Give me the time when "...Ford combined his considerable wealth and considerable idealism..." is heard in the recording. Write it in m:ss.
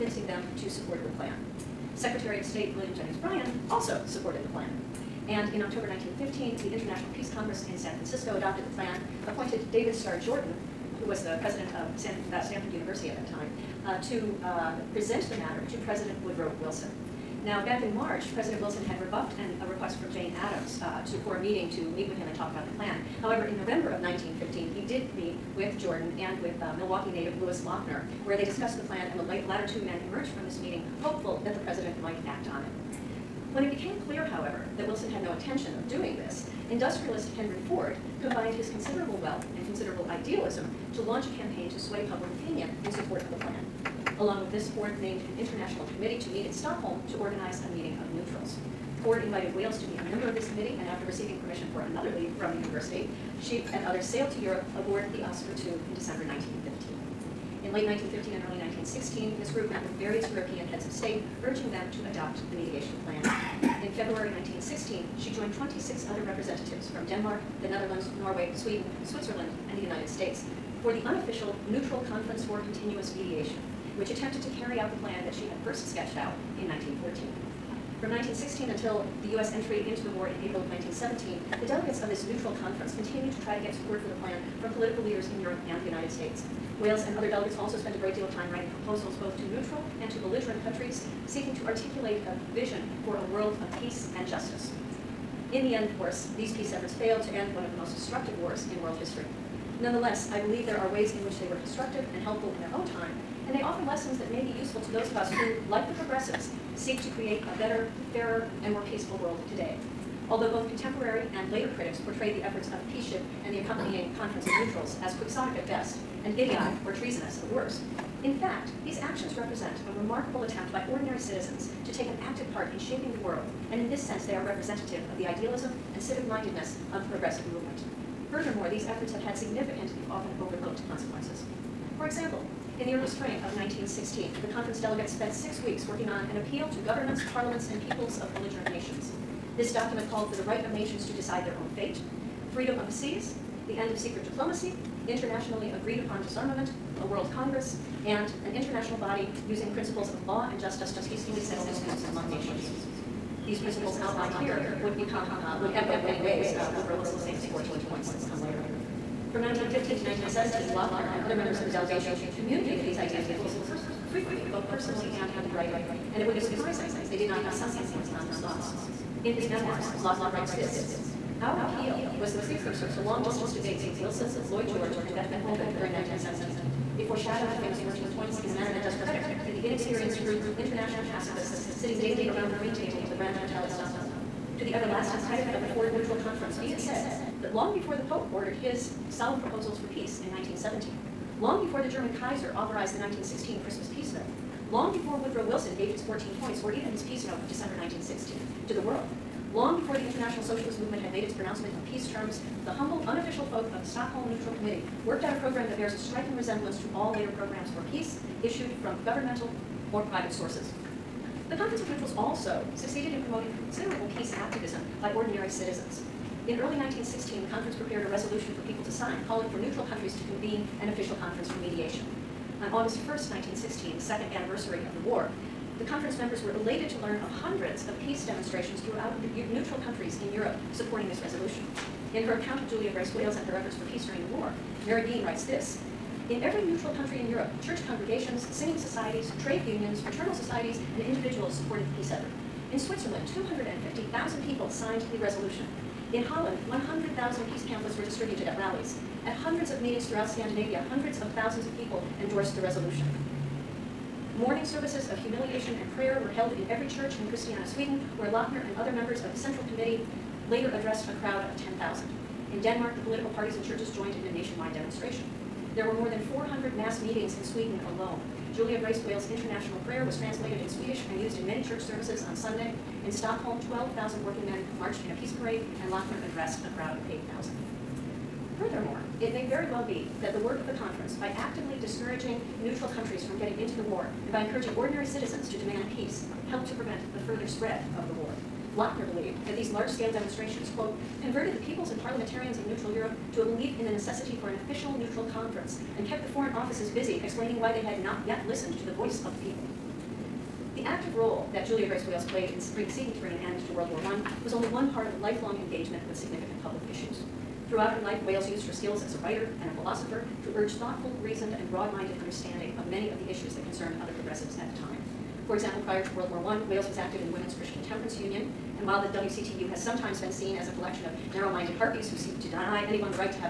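0:37.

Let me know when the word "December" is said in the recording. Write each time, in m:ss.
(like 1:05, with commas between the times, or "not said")
0:55, 3:17.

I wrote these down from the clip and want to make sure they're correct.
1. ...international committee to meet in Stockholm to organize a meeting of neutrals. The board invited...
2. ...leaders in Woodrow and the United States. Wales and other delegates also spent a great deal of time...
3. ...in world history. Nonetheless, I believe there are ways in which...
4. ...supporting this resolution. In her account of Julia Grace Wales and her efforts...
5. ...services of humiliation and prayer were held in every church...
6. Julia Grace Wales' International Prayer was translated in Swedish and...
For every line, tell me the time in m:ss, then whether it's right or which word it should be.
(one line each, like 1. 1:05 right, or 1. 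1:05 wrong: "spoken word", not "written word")
1. 0:45 right
2. 1:25 wrong: "Europe", not "Woodrow"
3. 1:38 right
4. 3:50 right
5. 4:14 right
6. 4:28 right.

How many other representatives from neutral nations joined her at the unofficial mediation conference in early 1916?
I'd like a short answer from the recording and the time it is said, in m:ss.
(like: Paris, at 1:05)
26, at 1:05.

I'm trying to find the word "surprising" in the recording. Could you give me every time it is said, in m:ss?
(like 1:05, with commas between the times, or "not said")
2:46.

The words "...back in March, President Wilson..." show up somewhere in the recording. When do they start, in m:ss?
0:17.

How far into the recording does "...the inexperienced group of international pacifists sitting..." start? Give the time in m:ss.
2:59.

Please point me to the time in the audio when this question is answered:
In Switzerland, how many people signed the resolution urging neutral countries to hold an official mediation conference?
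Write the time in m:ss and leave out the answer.
4:03.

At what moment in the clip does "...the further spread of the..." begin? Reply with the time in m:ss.
4:47.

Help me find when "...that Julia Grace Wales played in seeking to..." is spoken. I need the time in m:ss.
5:01.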